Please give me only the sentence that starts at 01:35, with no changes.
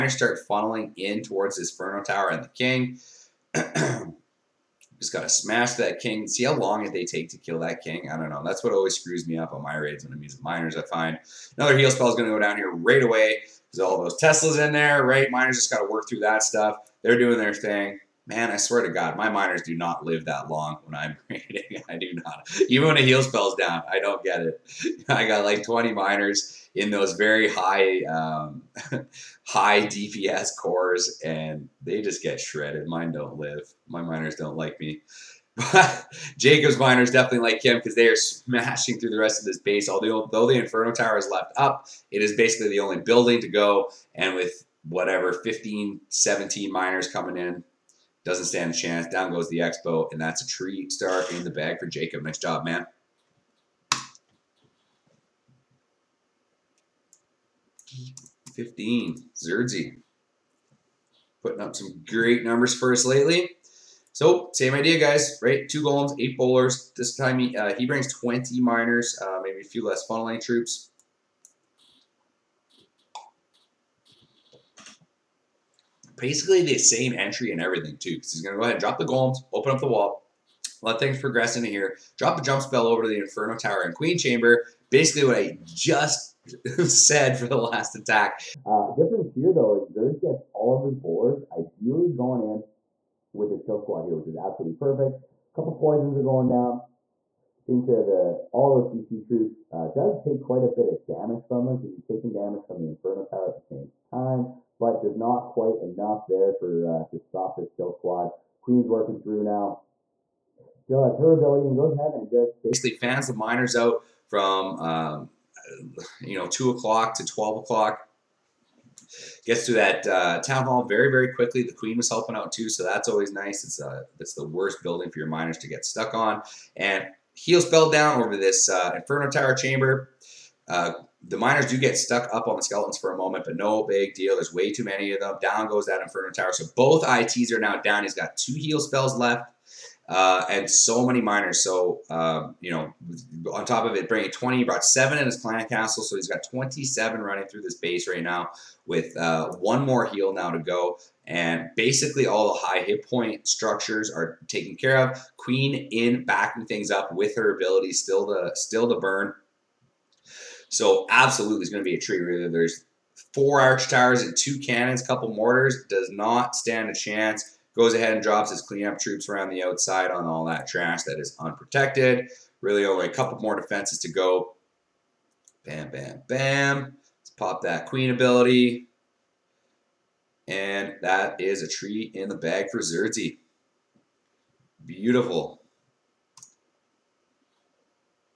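A couple poisons are going down taking care of the all those CC troops.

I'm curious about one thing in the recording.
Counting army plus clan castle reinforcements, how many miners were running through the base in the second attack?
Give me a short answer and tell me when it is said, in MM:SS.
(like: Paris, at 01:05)
27, at 02:26.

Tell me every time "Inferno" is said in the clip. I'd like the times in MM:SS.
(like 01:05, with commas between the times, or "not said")
00:40, 01:23, 01:42, 02:08, 02:16.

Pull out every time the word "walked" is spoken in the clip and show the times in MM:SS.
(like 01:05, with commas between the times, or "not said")
not said.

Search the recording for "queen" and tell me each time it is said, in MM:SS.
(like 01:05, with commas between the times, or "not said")
01:23, 01:48, 02:01, 02:35, 02:57.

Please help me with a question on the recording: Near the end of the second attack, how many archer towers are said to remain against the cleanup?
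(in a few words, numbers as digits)
4.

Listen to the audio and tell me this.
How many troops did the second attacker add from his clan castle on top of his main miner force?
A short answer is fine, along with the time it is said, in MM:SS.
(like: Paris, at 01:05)
7, at 02:24.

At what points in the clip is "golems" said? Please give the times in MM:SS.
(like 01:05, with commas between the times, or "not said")
01:05, 01:19.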